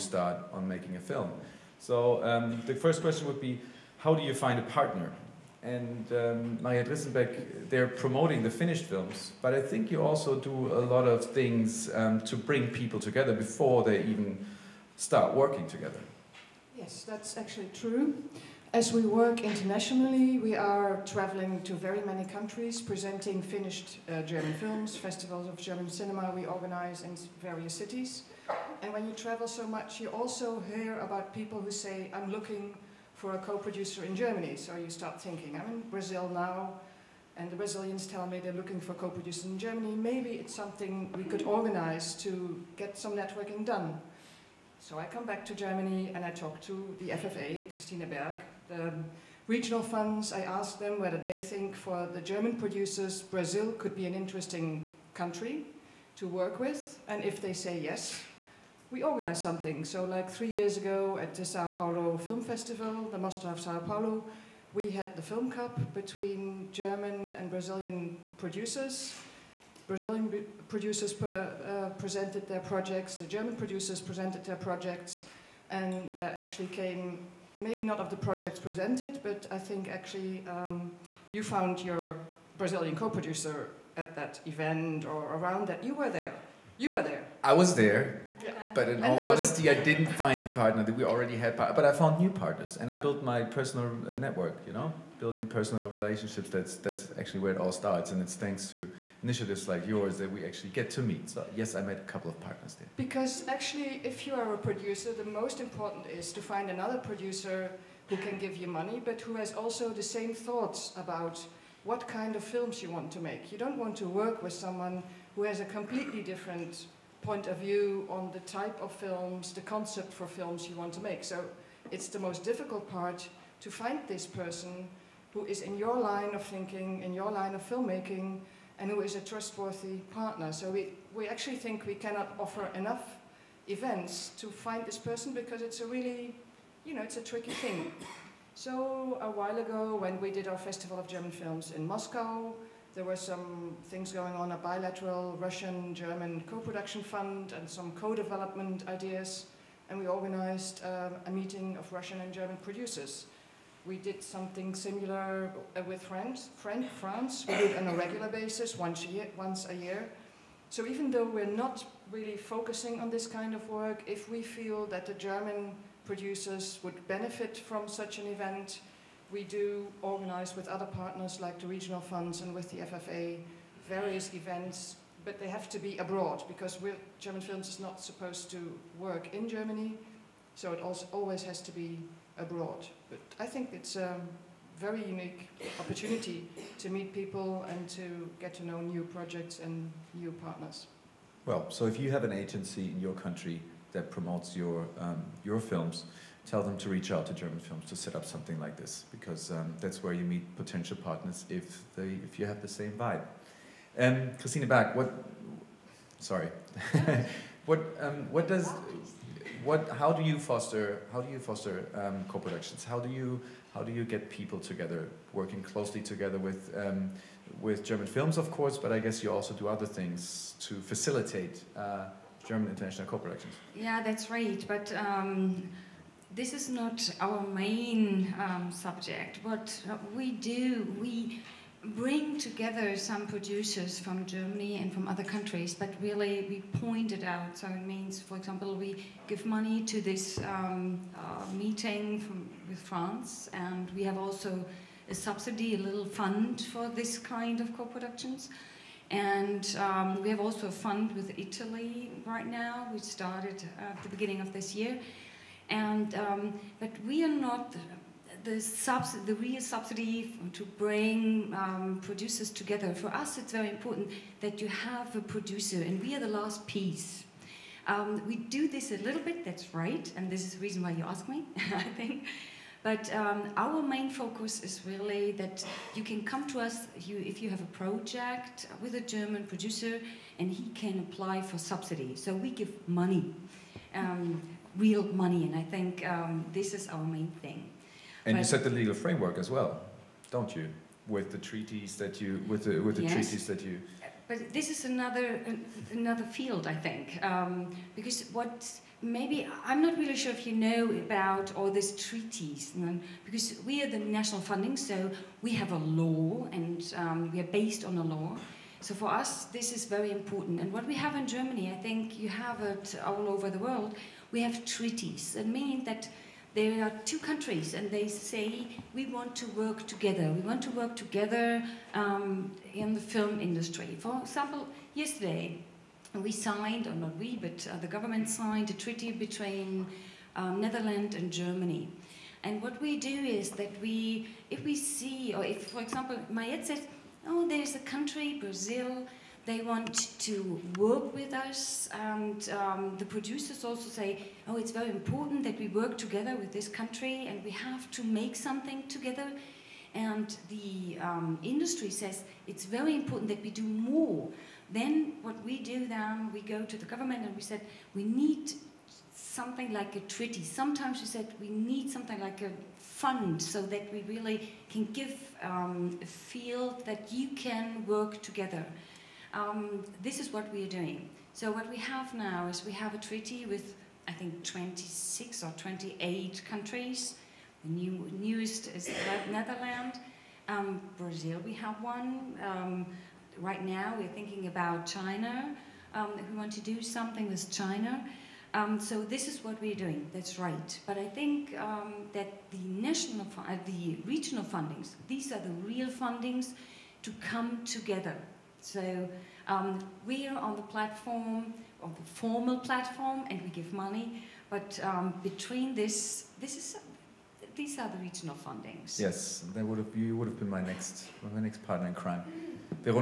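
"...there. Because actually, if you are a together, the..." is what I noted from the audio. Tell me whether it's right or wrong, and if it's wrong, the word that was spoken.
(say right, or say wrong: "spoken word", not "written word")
wrong: "producer", not "together".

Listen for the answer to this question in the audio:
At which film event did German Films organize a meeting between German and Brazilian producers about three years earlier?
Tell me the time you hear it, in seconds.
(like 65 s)
61 s.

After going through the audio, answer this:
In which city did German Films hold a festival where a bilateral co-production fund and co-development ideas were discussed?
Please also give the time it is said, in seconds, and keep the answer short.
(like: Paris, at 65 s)
Moscow, at 141 s.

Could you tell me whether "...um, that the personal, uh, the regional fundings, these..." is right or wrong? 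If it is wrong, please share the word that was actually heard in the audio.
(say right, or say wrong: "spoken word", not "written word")
wrong: "national", not "personal".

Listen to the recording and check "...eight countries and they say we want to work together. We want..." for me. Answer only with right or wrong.
wrong.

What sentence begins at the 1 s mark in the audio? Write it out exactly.
So um, the first question would be, how do you find a partner?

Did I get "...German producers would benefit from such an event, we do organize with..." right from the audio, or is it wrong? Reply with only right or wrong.
right.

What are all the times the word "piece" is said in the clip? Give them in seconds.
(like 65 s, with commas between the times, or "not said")
266 s.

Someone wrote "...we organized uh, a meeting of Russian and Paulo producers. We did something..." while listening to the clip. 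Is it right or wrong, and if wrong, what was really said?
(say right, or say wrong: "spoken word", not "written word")
wrong: "German", not "Paulo".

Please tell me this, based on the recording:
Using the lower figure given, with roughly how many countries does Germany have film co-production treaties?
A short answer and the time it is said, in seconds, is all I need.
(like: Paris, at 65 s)
26, at 374 s.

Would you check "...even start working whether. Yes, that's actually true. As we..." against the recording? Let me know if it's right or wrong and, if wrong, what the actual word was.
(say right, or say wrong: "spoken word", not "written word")
wrong: "together", not "whether".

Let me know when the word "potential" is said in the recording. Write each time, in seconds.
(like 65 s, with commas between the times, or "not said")
200 s.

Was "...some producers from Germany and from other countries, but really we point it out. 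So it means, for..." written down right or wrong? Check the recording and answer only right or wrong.
right.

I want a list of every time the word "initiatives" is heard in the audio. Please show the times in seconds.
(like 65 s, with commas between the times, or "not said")
99 s.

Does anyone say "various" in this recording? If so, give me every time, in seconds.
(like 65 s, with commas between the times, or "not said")
27 s, 173 s.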